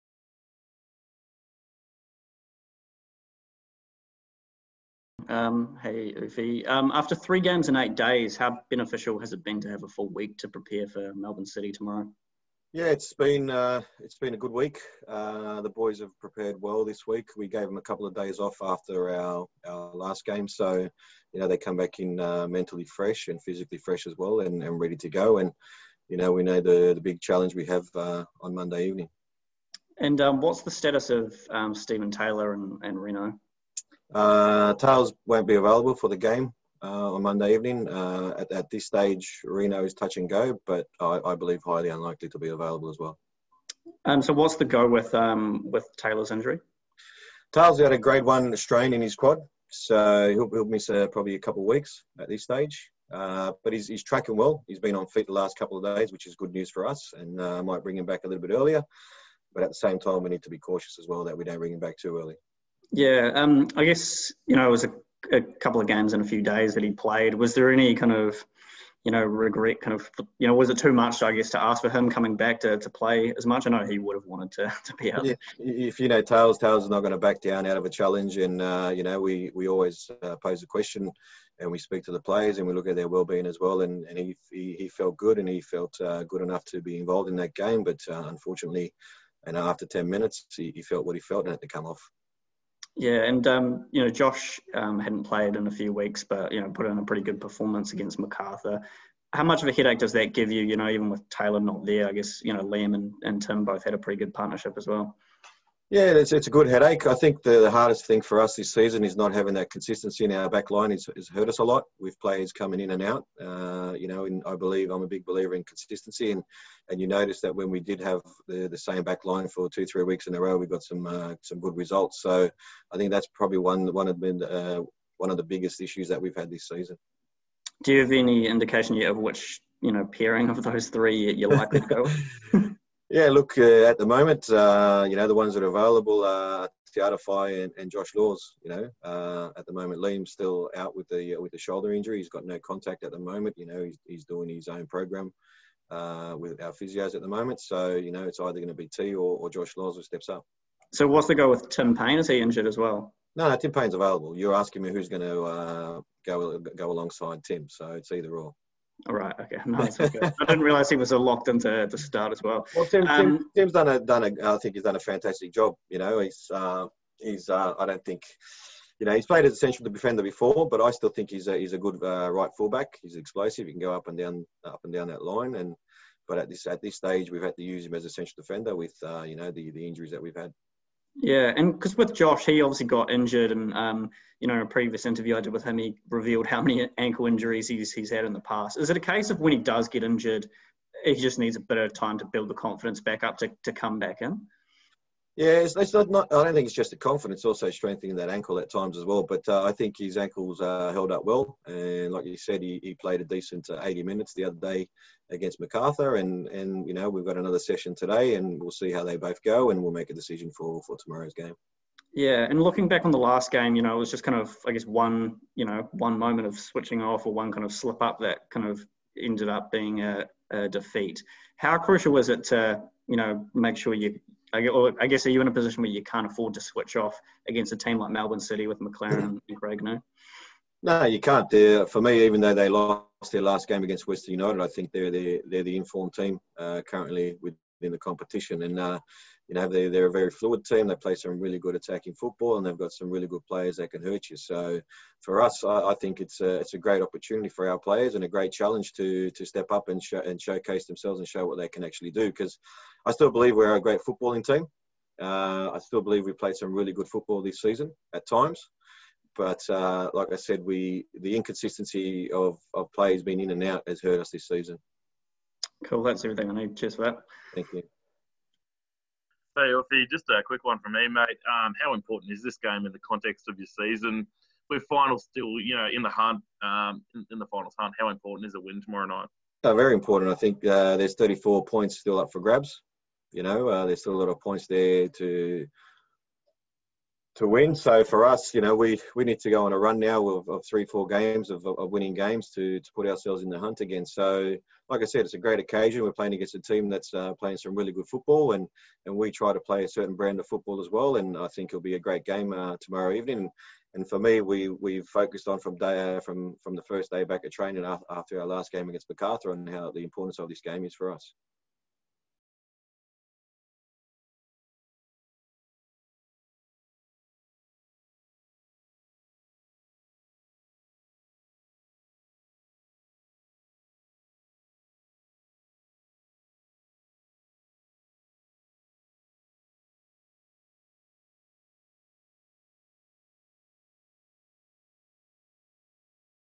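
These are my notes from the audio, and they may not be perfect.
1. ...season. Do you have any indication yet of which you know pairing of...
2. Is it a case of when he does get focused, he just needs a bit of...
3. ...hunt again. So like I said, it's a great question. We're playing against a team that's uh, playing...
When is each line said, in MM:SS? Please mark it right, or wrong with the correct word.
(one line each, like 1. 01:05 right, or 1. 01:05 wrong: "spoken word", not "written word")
1. 02:06 right
2. 03:08 wrong: "injured", not "focused"
3. 04:53 wrong: "occasion", not "question".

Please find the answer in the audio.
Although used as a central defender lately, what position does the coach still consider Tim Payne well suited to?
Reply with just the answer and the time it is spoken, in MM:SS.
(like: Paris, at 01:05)
Right fullback, at 02:52.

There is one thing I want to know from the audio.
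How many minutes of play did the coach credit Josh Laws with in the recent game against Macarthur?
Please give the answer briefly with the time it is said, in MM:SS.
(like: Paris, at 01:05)
80, at 03:23.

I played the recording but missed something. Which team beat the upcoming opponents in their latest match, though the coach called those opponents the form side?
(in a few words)
Western United.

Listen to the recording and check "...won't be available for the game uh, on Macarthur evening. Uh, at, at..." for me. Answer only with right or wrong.
wrong.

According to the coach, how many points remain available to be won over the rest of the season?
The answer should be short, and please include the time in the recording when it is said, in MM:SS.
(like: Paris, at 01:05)
34, at 04:41.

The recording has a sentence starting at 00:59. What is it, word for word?
But at the same time, we need to be cautious as well that we don't bring him back too early.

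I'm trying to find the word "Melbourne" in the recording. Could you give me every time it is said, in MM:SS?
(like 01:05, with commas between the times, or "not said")
00:11, 03:48.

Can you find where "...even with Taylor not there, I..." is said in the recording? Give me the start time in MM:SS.
01:40.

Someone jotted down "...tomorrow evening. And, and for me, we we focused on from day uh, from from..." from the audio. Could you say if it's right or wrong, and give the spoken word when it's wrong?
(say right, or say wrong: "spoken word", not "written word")
right.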